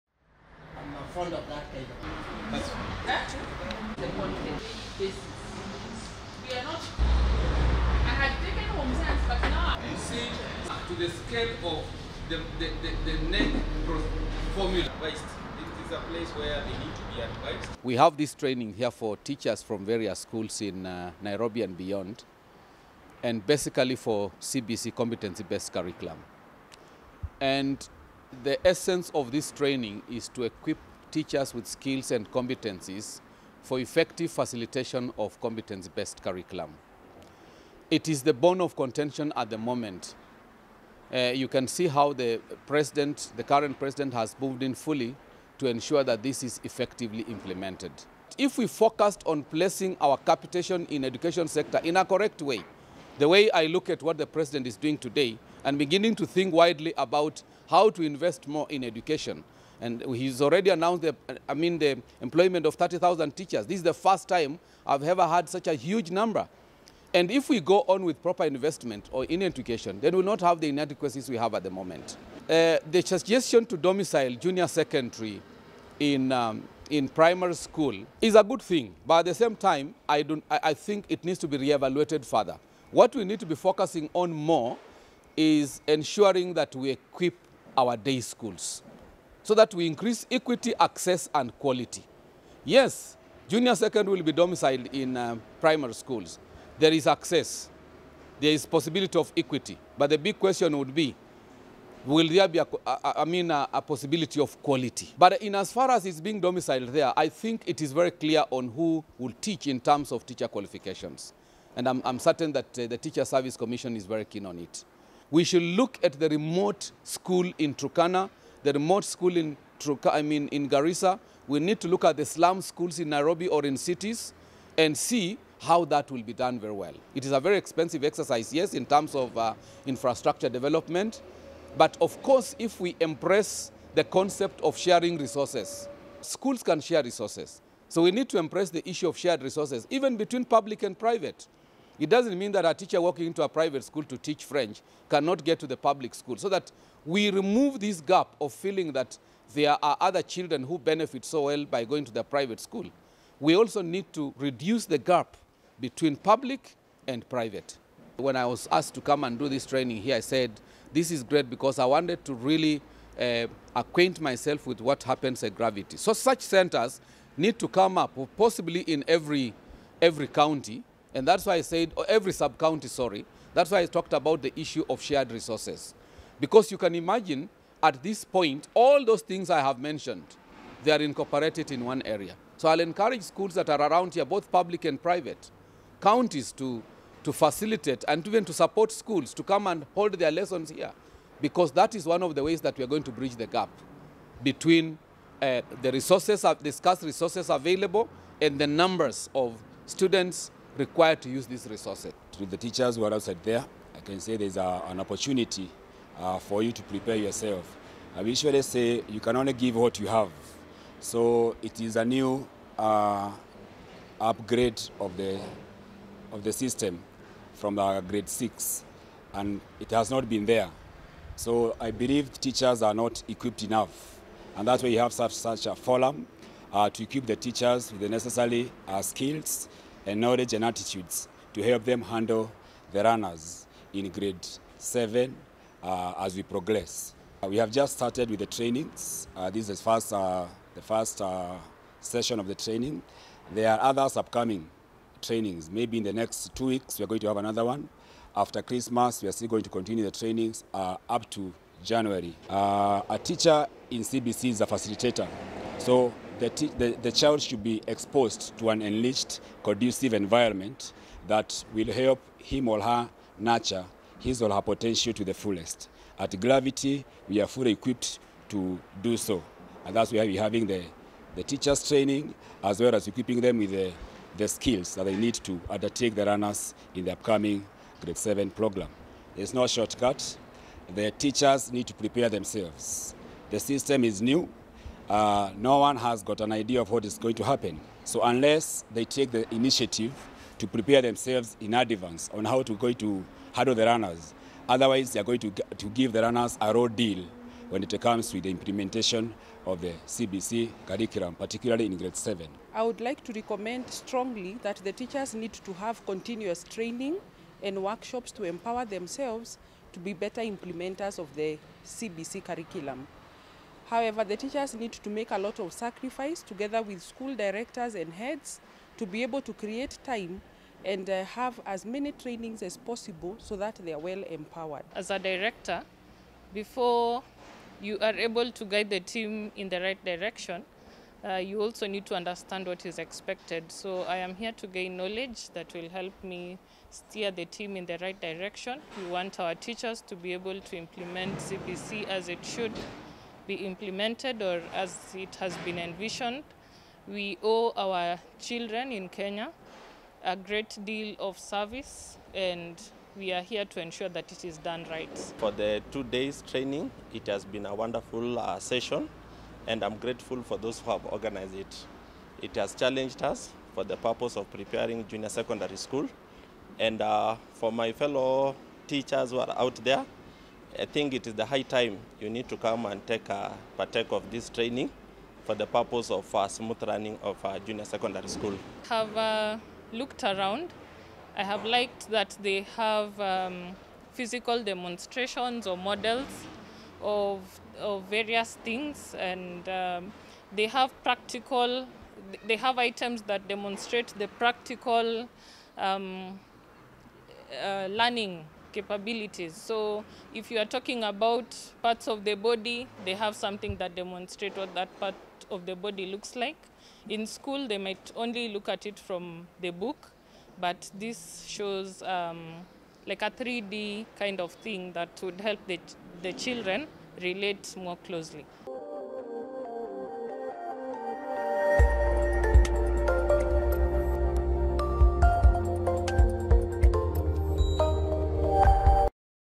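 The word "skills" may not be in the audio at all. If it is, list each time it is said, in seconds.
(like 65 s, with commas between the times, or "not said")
31 s, 229 s, 274 s.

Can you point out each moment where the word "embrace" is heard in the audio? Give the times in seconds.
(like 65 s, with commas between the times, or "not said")
132 s, 138 s.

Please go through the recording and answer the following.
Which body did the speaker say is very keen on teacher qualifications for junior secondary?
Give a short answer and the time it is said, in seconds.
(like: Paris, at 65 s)
Teacher Service Commission, at 112 s.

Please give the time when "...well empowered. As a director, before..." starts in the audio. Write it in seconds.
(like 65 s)
323 s.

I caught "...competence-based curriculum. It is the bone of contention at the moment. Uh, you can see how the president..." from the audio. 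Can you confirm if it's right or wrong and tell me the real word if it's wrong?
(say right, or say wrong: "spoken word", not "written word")
right.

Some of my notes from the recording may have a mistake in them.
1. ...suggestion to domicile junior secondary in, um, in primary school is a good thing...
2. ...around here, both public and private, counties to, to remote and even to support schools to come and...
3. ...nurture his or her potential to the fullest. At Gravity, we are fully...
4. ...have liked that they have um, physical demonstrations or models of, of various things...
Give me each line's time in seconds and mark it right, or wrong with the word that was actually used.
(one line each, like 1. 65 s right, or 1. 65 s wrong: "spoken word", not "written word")
1. 73 s right
2. 183 s wrong: "facilitate", not "remote"
3. 263 s right
4. 381 s right.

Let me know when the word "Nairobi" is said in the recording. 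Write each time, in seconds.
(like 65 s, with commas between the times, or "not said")
21 s, 123 s.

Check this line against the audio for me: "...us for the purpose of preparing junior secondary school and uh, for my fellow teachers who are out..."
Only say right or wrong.
right.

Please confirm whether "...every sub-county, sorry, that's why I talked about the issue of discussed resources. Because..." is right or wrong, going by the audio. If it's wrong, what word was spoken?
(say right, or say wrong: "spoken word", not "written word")
wrong: "shared", not "discussed".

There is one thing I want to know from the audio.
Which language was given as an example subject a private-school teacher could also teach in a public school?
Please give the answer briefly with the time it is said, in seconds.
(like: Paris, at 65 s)
French, at 144 s.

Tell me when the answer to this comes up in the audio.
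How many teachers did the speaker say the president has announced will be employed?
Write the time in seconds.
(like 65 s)
62 s.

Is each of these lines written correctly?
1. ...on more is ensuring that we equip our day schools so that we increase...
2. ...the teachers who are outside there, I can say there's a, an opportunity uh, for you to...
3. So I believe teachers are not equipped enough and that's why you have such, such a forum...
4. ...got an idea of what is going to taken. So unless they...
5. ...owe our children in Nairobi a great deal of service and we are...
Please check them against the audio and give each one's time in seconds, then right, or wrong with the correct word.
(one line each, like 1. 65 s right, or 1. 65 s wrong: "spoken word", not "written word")
1. 84 s right
2. 202 s right
3. 221 s right
4. 286 s wrong: "happen", not "taken"
5. 347 s wrong: "Kenya", not "Nairobi".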